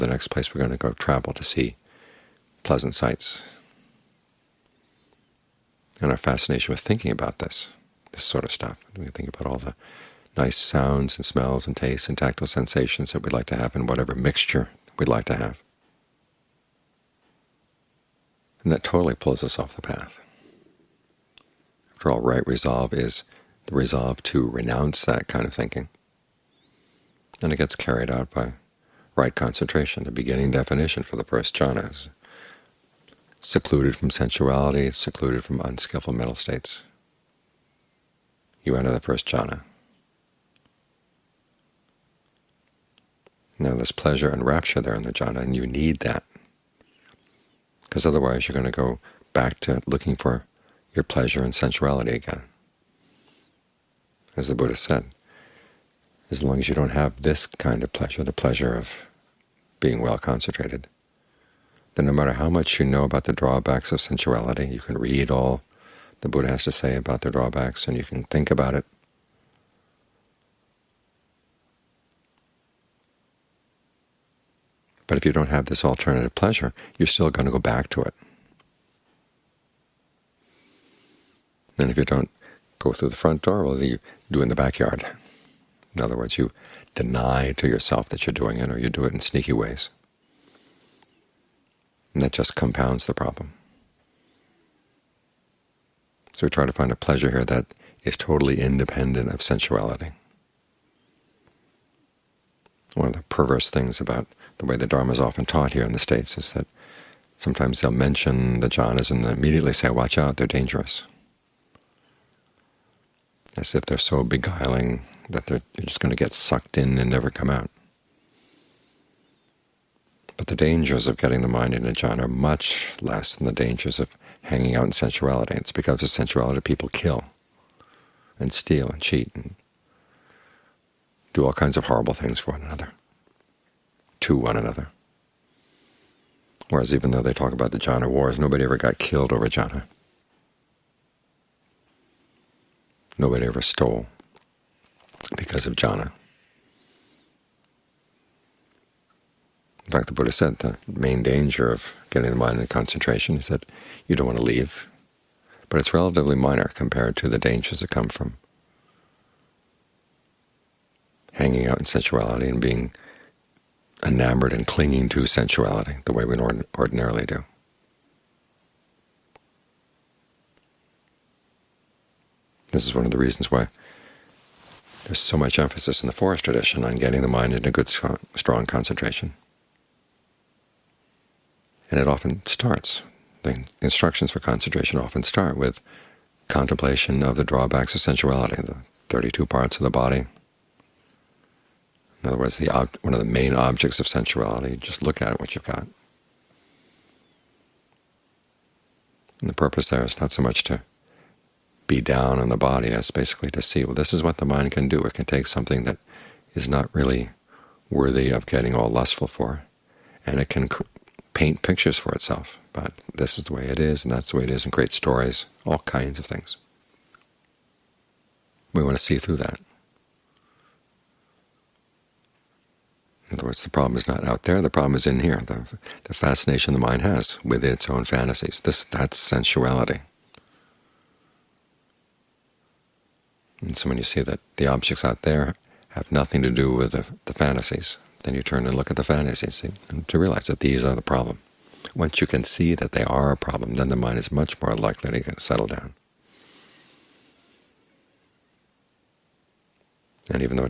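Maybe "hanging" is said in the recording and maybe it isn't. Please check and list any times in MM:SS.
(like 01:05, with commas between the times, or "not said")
02:04, 02:41.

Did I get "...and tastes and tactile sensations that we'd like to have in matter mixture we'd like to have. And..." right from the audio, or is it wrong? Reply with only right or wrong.
wrong.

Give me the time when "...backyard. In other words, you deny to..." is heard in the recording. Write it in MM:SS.
01:24.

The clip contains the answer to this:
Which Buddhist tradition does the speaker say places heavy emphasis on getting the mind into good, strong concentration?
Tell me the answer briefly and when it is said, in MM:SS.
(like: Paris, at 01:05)
the forest tradition, at 02:56.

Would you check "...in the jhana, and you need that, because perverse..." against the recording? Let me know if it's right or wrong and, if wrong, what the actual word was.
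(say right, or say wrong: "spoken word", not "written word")
wrong: "otherwise", not "perverse".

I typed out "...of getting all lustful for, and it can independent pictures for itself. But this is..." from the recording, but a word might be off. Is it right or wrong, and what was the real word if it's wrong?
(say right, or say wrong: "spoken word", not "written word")
wrong: "paint", not "independent".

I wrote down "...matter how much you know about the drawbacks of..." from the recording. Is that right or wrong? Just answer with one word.
right.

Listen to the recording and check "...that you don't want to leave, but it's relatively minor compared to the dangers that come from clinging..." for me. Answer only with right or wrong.
wrong.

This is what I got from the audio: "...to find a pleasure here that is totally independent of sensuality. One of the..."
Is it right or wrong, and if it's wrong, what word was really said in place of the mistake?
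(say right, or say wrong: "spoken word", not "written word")
right.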